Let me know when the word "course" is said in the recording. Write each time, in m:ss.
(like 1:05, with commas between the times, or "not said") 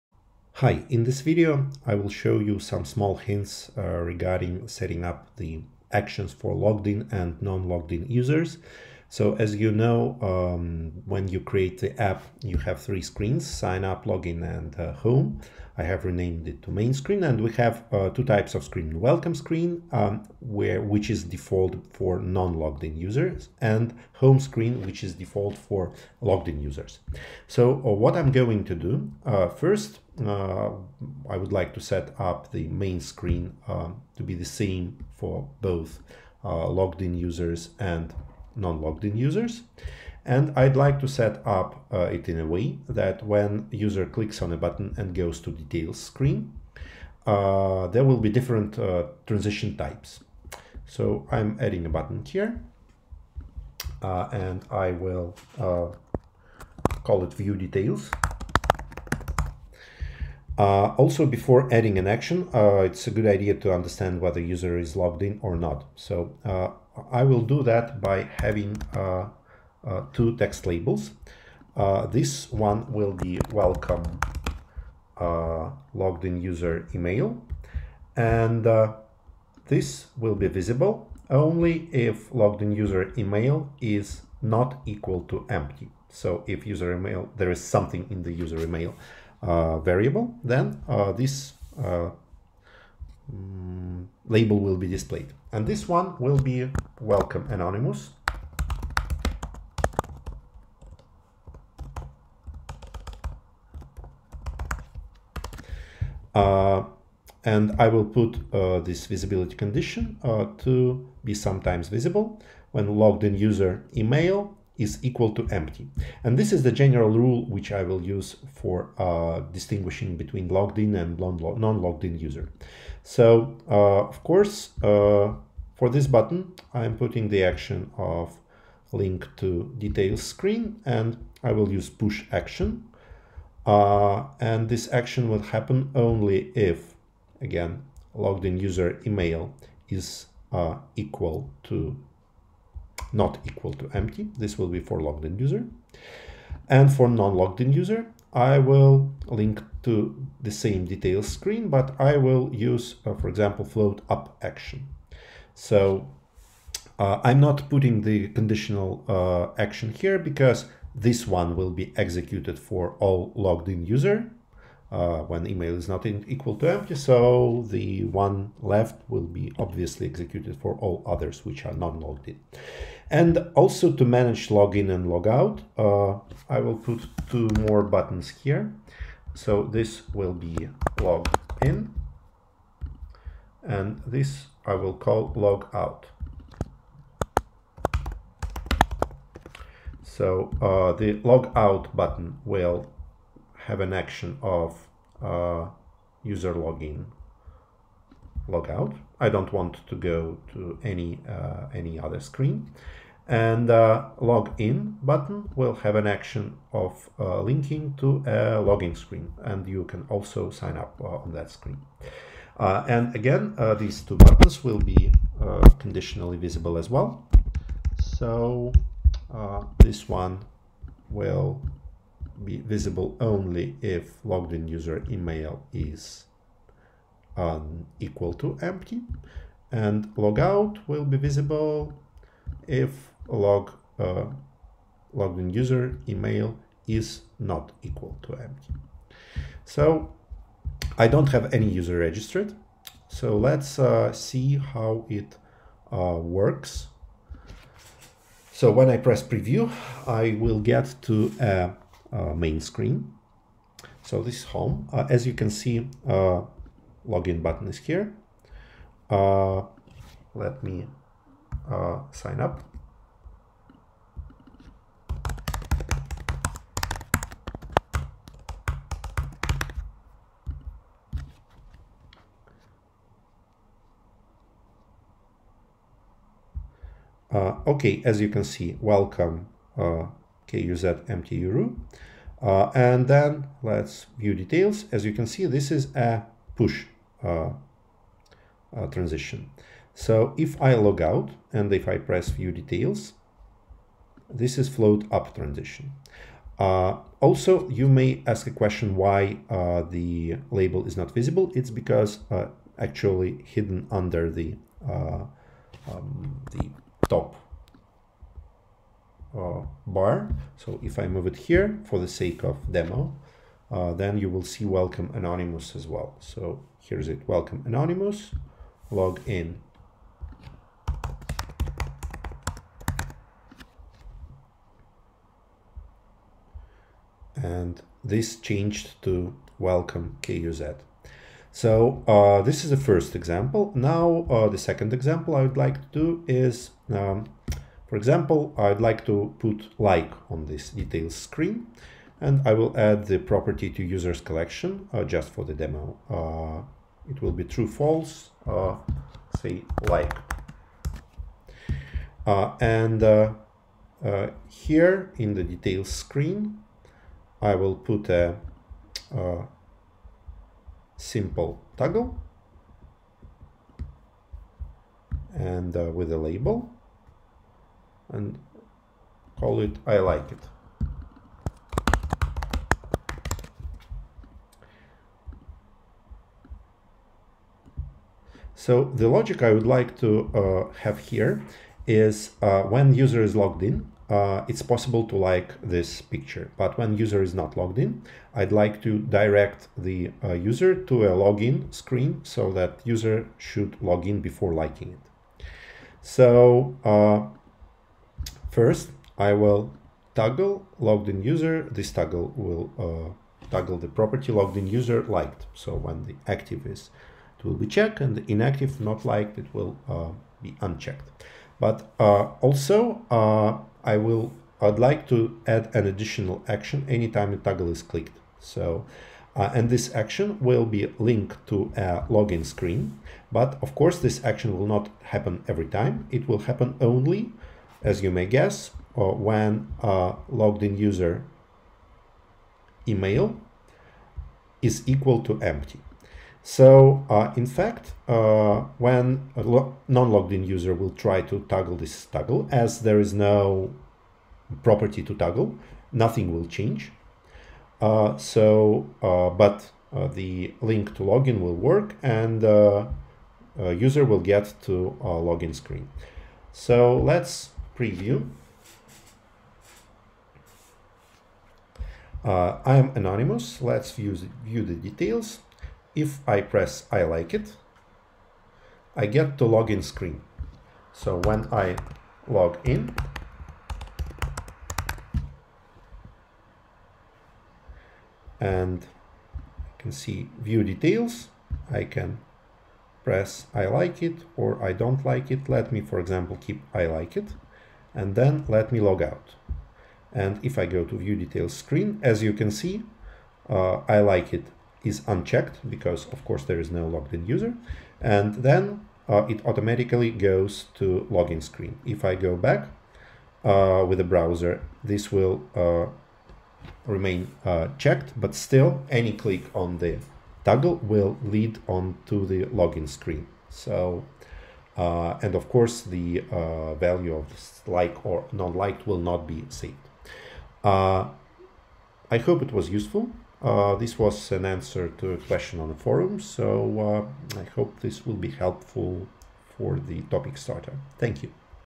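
2:04, 7:03, 8:16, 8:35.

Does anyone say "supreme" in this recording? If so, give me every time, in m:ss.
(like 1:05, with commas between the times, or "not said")
not said.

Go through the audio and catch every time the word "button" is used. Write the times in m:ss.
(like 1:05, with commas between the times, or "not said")
0:44, 0:51, 2:06, 2:57, 3:11, 3:25, 3:34, 4:17.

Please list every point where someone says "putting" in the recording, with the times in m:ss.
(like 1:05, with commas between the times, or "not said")
2:06, 2:37.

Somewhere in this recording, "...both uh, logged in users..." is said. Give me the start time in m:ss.
0:35.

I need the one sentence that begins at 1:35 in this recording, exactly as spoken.
And this one will be welcome anonymous.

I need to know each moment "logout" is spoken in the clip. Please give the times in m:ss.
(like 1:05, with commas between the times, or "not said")
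2:55, 3:50.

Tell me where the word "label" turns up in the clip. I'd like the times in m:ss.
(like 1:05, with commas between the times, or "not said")
1:10, 1:34, 5:00, 6:06.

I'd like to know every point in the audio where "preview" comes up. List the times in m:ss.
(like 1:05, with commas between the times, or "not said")
4:09, 7:37.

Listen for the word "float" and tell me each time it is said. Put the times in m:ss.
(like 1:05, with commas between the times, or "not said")
2:33, 4:54.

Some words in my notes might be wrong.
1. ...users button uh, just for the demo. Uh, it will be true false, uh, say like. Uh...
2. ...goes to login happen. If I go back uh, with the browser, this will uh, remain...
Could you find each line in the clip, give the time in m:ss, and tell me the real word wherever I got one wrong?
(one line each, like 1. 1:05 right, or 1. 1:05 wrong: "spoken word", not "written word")
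1. 5:43 wrong: "collection", not "button"
2. 8:20 wrong: "screen", not "happen".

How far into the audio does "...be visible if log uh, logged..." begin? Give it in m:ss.
3:51.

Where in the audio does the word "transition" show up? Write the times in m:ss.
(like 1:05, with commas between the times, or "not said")
0:49, 4:48, 4:55.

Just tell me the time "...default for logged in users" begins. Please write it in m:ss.
0:25.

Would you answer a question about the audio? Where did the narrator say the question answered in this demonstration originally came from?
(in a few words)
the forum.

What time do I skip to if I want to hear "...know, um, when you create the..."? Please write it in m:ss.
0:09.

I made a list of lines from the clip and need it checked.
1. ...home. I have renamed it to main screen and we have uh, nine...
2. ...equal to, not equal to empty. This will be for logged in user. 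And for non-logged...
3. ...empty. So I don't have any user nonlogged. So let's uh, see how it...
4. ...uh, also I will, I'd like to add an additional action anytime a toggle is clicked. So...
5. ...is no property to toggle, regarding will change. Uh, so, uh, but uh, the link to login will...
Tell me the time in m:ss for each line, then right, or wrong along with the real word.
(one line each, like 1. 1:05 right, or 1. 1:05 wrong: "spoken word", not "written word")
1. 0:14 wrong: "two", not "nine"
2. 2:20 right
3. 3:58 wrong: "registered", not "nonlogged"
4. 6:51 right
5. 7:22 wrong: "nothing", not "regarding".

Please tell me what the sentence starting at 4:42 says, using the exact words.
Uh, and then let's view details.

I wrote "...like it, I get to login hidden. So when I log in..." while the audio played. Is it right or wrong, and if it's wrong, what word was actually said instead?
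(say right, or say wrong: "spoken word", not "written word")
wrong: "screen", not "hidden".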